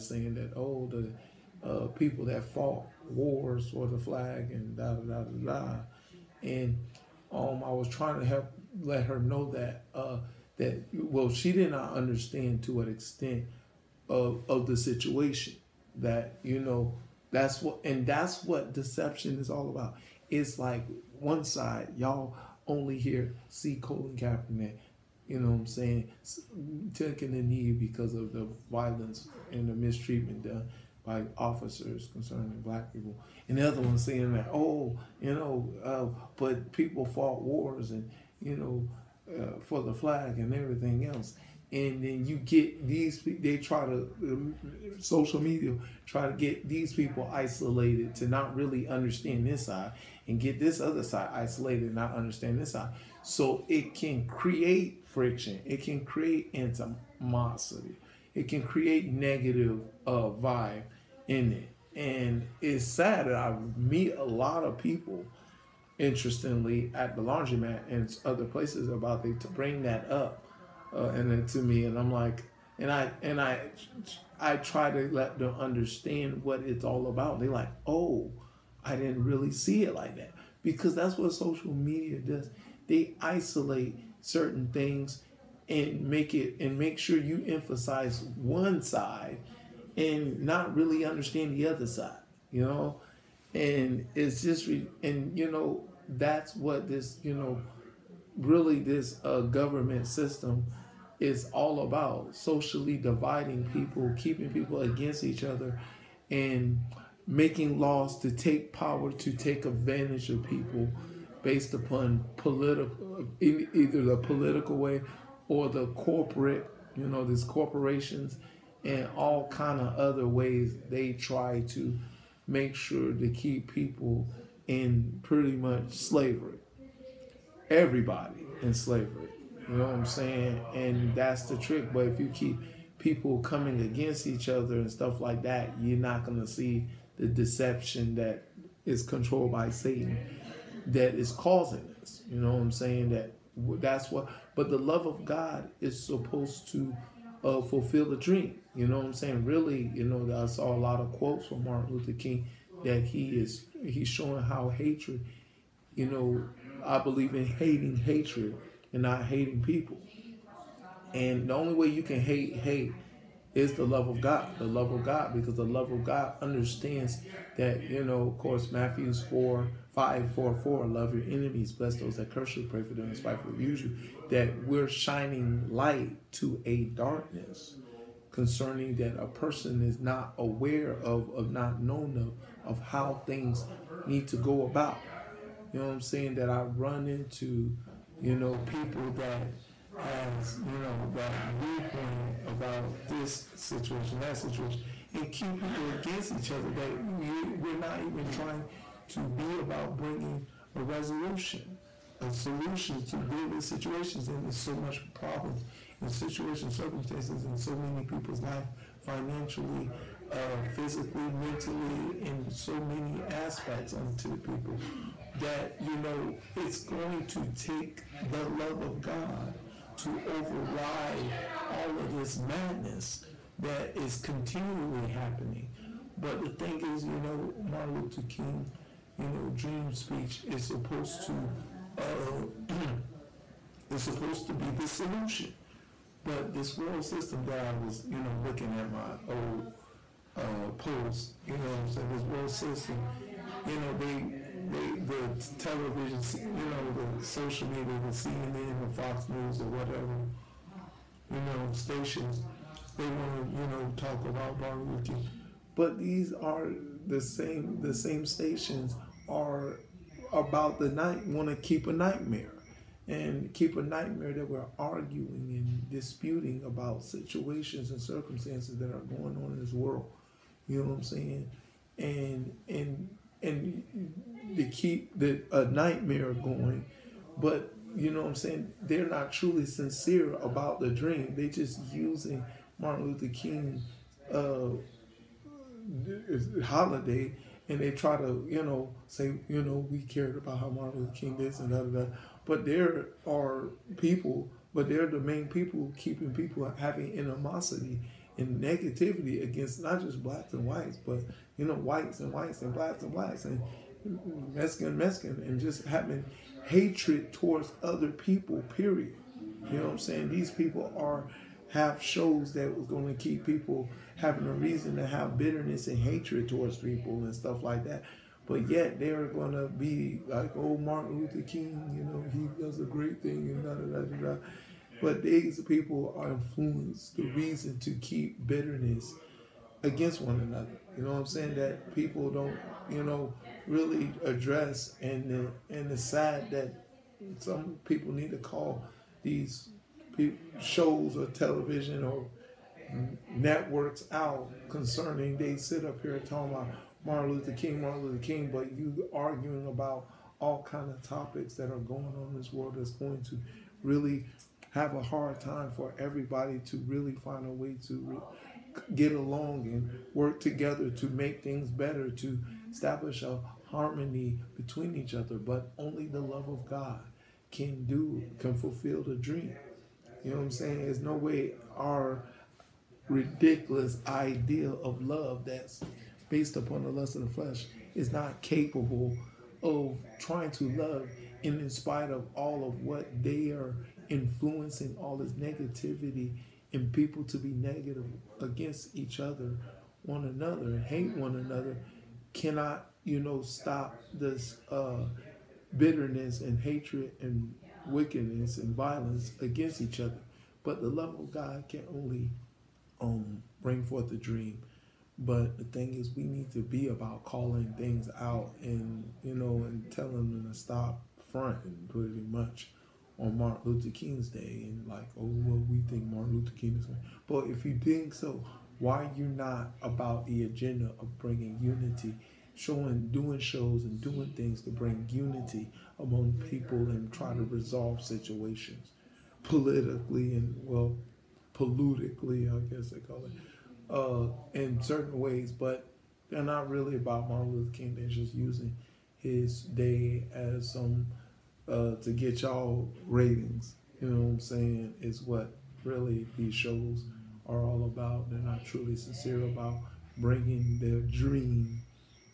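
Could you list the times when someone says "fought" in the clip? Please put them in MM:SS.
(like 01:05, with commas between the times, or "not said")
00:02, 00:37.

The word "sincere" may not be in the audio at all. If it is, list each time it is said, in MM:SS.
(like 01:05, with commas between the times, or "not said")
04:39, 07:28.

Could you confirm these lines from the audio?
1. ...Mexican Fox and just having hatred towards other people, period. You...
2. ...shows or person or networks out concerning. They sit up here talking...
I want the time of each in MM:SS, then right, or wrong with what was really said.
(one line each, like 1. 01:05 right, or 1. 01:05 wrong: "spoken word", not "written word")
1. 05:04 wrong: "Mexican", not "Fox"
2. 05:40 wrong: "television", not "person".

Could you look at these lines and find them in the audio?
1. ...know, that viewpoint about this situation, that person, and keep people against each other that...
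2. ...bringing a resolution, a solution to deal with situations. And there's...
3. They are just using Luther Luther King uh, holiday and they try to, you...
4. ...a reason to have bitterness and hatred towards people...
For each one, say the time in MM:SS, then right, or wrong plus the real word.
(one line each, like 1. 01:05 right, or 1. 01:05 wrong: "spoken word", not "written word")
1. 03:10 wrong: "situation", not "person"
2. 03:19 right
3. 04:41 wrong: "Martin", not "Luther"
4. 05:14 right.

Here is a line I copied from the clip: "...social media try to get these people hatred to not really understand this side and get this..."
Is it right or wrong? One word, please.
wrong.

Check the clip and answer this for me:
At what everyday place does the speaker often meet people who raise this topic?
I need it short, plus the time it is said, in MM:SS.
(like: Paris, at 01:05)
laundromat, at 01:07.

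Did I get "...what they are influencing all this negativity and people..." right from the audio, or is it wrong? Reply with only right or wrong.
right.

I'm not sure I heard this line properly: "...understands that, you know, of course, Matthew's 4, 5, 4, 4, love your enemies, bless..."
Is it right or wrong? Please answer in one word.
right.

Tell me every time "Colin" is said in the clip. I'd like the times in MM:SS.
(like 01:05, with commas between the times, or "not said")
00:23.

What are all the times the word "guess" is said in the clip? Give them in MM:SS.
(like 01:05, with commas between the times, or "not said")
07:12.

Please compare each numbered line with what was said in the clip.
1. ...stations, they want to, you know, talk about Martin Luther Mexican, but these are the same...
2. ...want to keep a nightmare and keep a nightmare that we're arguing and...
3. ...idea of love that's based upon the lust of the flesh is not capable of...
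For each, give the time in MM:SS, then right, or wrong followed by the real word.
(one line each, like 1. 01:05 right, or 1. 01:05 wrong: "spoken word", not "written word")
1. 04:11 wrong: "King", not "Mexican"
2. 04:21 right
3. 06:14 right.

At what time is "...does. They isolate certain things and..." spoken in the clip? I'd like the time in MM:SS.
01:22.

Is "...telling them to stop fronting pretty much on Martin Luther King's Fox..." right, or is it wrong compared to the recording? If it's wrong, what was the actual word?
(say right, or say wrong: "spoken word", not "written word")
wrong: "Day", not "Fox".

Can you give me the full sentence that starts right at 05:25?
But these people are influenced the reason to keep bitterness against one another.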